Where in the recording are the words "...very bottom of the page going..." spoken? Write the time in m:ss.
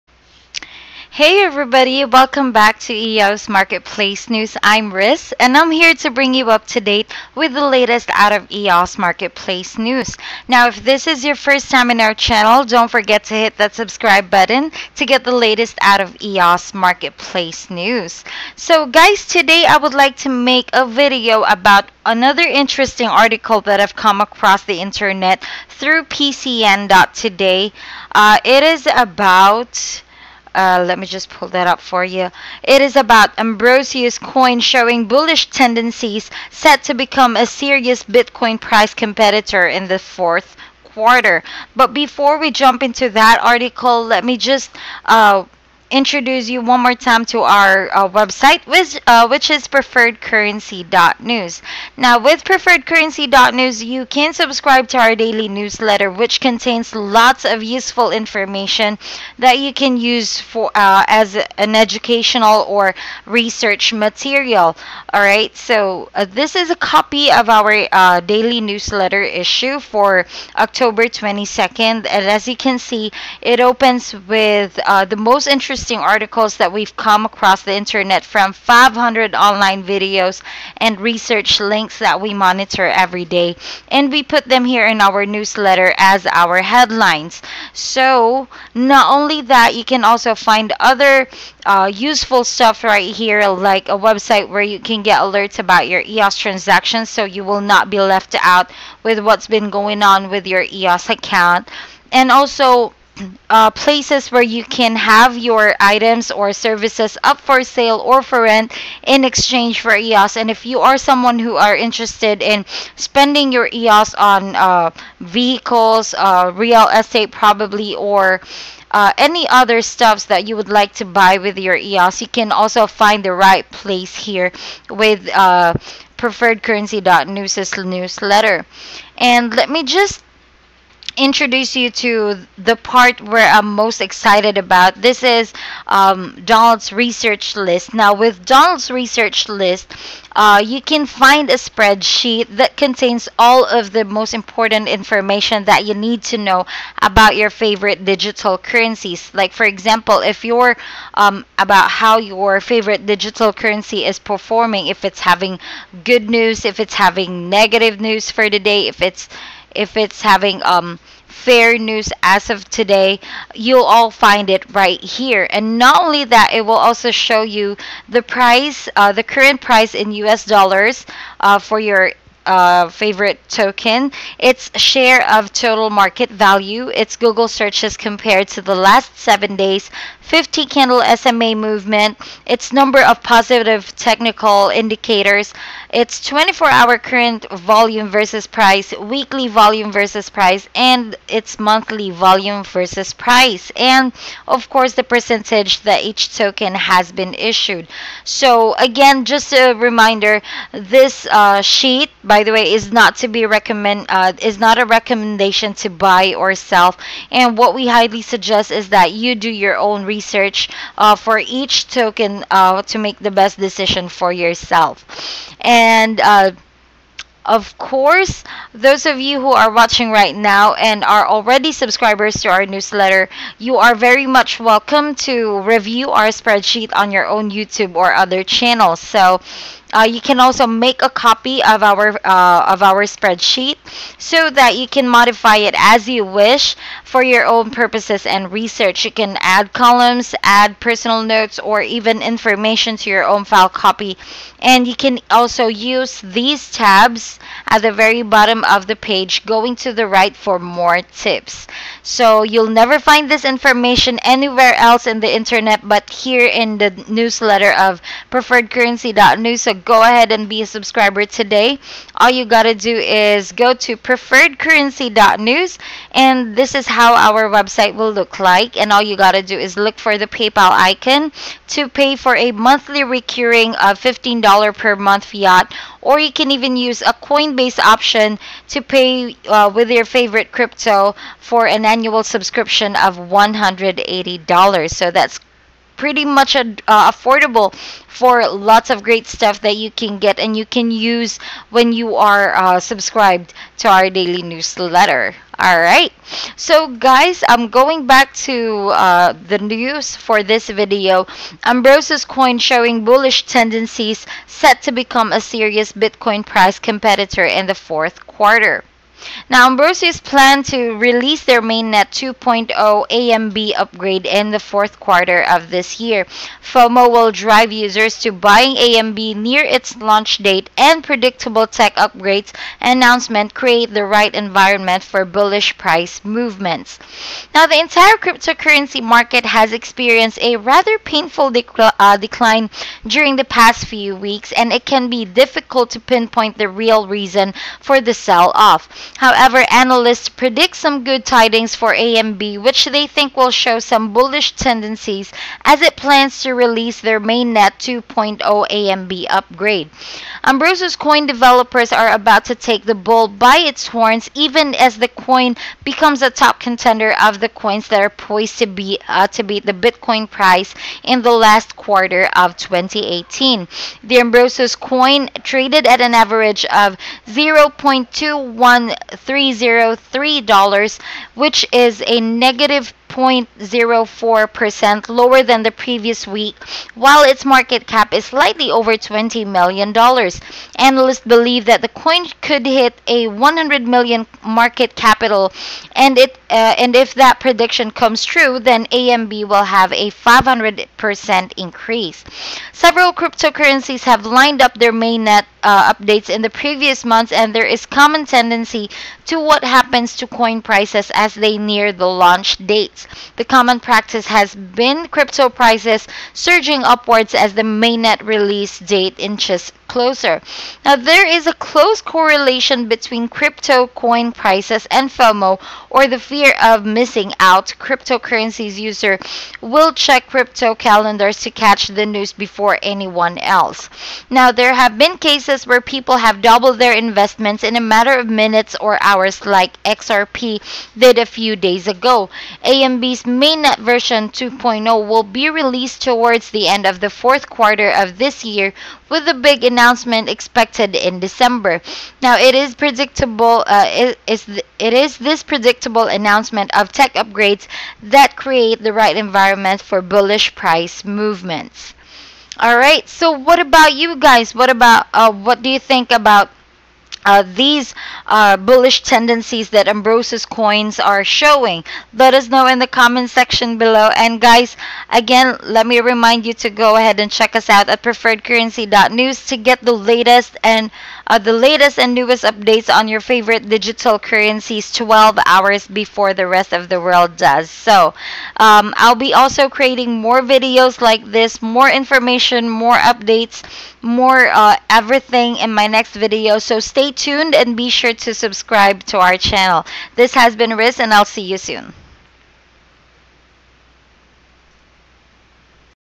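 4:07.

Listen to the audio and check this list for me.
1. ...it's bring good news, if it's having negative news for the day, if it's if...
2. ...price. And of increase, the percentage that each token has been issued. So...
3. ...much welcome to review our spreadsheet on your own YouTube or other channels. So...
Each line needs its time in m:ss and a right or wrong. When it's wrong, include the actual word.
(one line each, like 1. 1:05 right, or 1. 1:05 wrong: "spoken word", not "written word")
1. 2:35 wrong: "having", not "bring"
2. 3:13 wrong: "course", not "increase"
3. 3:44 right.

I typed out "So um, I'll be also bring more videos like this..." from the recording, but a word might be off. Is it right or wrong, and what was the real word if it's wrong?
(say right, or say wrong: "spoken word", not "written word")
wrong: "creating", not "bring".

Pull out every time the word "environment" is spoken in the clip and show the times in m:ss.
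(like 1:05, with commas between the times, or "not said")
5:24, 7:29.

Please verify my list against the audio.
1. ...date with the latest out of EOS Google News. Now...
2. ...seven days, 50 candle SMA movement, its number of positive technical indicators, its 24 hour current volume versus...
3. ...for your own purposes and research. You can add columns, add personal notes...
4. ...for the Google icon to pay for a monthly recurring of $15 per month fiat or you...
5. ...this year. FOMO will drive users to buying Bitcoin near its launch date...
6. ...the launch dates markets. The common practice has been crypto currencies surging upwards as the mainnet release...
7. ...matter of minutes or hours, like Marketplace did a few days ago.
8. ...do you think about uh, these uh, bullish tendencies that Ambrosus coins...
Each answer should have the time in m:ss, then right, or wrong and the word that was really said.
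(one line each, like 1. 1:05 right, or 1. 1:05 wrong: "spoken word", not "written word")
1. 0:06 wrong: "Marketplace", not "Google"
2. 2:59 right
3. 3:57 right
4. 4:29 wrong: "PayPal", not "Google"
5. 5:15 wrong: "AMB", not "Bitcoin"
6. 6:41 wrong: "prices", not "currencies"
7. 7:07 wrong: "XRP", not "Marketplace"
8. 7:35 right.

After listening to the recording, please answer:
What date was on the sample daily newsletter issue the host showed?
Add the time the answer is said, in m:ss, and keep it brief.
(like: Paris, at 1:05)
October 22nd, at 1:10.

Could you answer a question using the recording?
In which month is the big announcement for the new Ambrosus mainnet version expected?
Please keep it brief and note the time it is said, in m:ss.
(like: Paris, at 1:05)
December, at 7:21.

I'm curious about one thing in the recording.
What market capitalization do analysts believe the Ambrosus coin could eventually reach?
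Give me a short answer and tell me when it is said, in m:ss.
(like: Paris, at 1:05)
100 million, at 6:23.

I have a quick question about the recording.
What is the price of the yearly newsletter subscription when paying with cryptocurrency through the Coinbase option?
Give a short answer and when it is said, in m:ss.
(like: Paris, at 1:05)
$180, at 4:43.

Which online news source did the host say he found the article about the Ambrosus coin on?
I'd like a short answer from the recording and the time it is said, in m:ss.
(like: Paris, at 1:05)
PCN.today, at 0:26.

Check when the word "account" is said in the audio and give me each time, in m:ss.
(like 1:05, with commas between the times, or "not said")
1:41.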